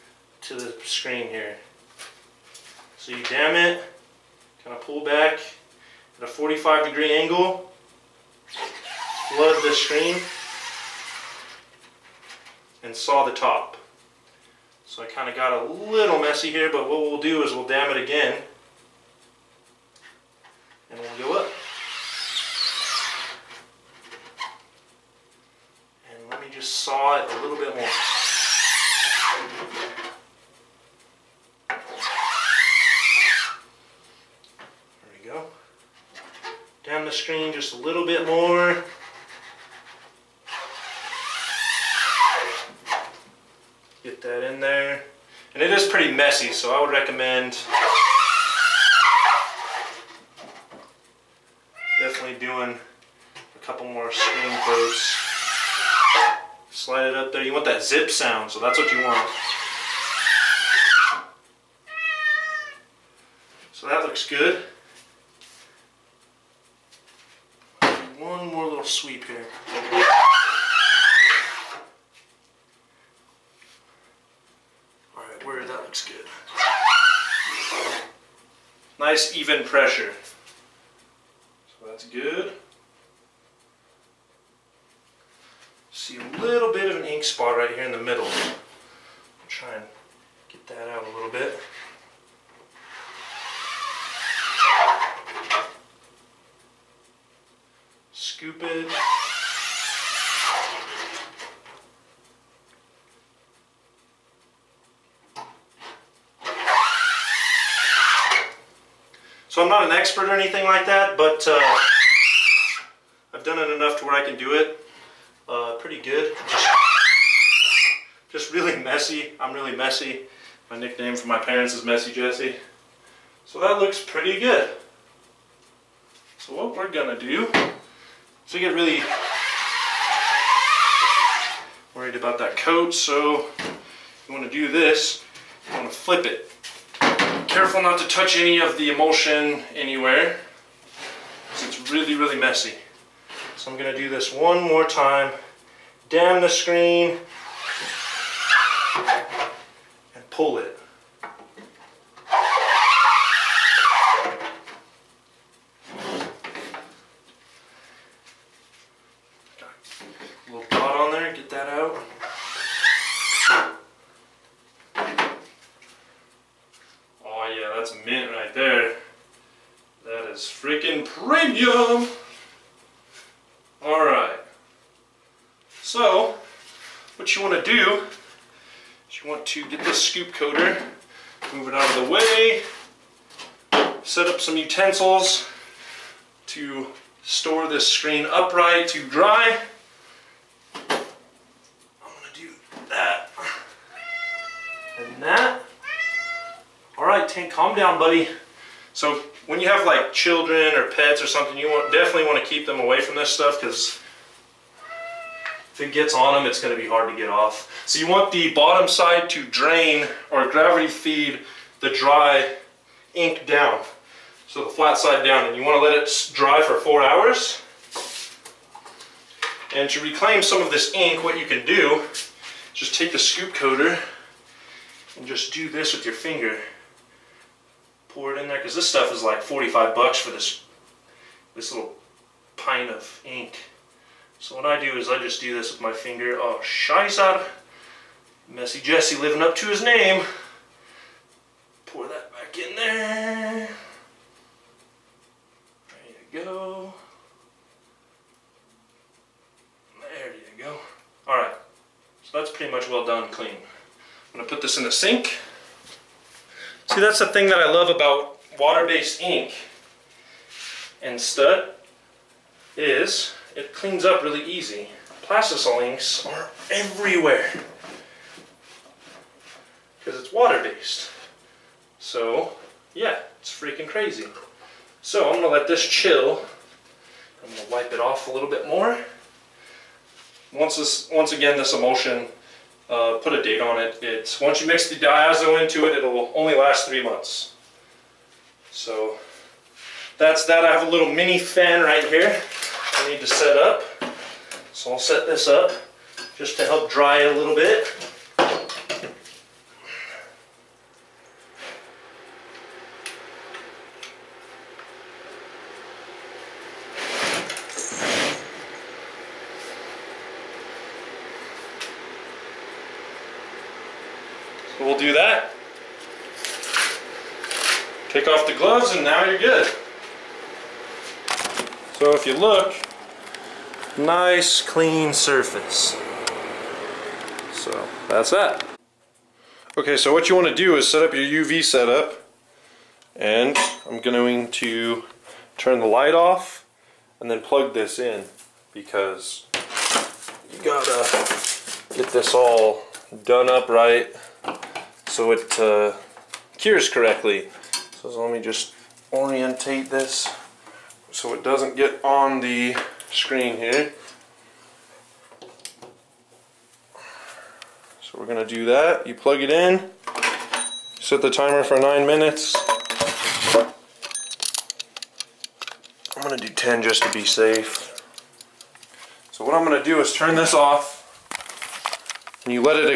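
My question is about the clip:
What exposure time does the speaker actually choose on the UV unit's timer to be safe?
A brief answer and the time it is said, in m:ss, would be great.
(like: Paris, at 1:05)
10 minutes, at 6:06.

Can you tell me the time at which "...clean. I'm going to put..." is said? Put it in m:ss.
4:13.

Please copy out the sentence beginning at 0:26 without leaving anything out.
And let me just saw it a little bit more.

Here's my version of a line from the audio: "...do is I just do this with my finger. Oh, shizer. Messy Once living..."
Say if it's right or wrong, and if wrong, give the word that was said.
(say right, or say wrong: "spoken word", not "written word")
wrong: "Jesse", not "Once".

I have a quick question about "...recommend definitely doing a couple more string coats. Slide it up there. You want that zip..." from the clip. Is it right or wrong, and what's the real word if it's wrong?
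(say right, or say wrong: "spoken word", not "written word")
right.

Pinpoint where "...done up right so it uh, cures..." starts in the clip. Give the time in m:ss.
5:43.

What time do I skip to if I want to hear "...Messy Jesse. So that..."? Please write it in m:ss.
2:01.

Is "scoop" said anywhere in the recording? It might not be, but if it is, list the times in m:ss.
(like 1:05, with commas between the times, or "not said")
3:00, 3:43.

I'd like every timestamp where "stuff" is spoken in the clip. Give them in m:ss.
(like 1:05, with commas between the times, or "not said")
3:23, 3:48.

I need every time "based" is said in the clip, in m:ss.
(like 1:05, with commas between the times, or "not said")
4:18, 4:30.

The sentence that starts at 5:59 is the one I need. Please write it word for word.
You plug it in, set the timer for nine minutes.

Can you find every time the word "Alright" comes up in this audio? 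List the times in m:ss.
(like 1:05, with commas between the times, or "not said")
1:15, 2:53, 3:16.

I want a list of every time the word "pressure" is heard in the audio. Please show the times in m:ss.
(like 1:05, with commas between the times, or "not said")
1:19.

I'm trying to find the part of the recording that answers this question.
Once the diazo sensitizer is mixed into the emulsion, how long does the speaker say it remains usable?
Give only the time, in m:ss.
4:46.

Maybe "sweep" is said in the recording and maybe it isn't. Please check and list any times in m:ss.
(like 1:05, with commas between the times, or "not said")
1:09.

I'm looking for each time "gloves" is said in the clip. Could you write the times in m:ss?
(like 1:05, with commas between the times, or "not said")
5:18.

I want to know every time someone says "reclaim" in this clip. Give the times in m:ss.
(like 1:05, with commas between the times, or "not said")
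3:40.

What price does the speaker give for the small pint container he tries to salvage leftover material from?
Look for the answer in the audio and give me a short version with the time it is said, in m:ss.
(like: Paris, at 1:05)
$45, at 3:49.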